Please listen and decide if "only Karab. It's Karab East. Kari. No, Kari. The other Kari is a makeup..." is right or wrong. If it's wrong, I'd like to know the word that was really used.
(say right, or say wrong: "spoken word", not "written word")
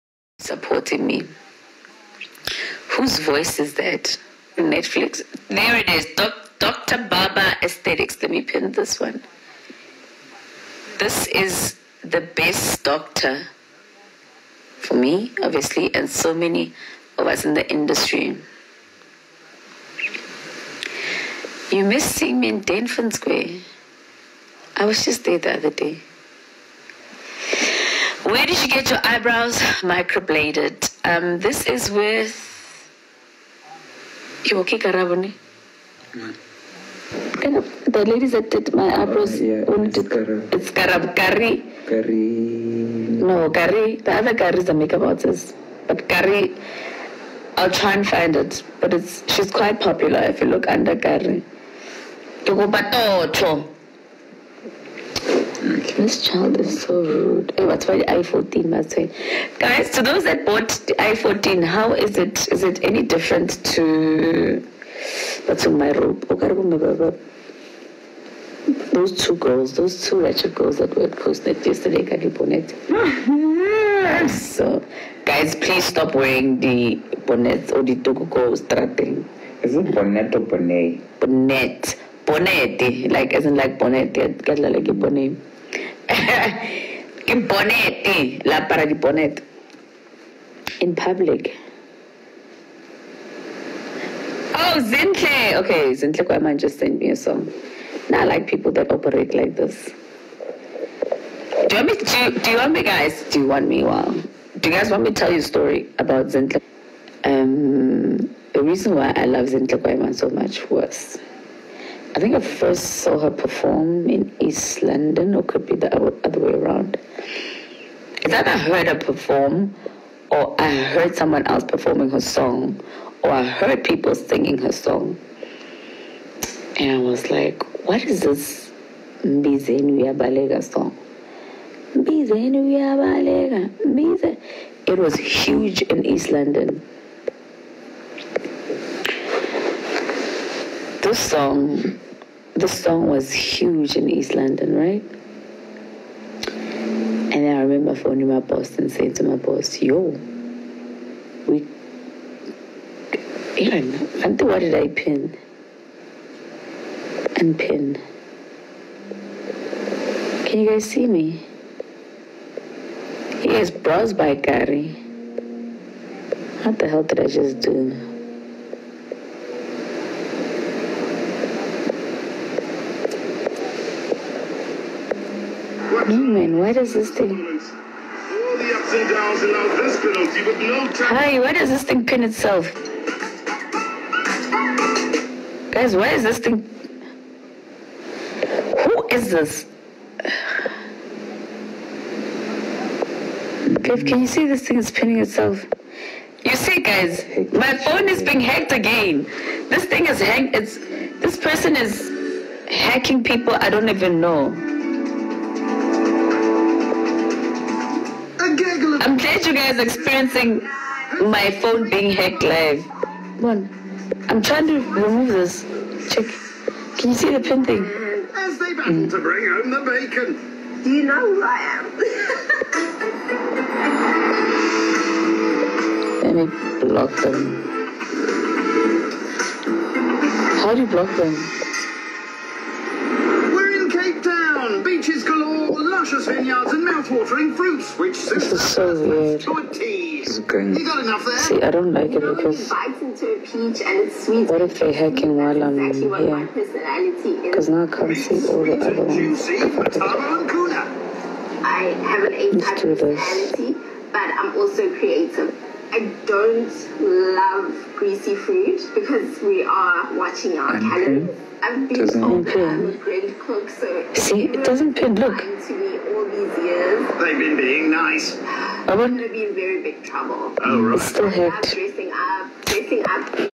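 wrong: "Kari", not "East".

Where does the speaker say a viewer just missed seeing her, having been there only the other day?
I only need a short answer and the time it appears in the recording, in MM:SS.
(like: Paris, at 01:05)
Denford Square, at 00:22.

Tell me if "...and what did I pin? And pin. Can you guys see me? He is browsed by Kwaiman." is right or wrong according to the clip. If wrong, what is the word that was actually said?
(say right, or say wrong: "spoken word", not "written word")
wrong: "Gary", not "Kwaiman".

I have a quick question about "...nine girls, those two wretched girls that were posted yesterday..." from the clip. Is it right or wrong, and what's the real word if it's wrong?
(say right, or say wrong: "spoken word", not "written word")
wrong: "two", not "nine".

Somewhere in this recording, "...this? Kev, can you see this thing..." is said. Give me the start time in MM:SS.
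03:09.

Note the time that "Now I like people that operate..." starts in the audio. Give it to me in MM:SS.
01:38.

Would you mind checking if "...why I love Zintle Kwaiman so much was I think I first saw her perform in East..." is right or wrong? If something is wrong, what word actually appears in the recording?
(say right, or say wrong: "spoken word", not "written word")
right.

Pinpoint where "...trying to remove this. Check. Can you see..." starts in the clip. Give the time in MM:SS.
03:34.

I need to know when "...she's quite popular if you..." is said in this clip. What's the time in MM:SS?
00:49.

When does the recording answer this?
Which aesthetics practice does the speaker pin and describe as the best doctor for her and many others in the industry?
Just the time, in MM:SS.
00:06.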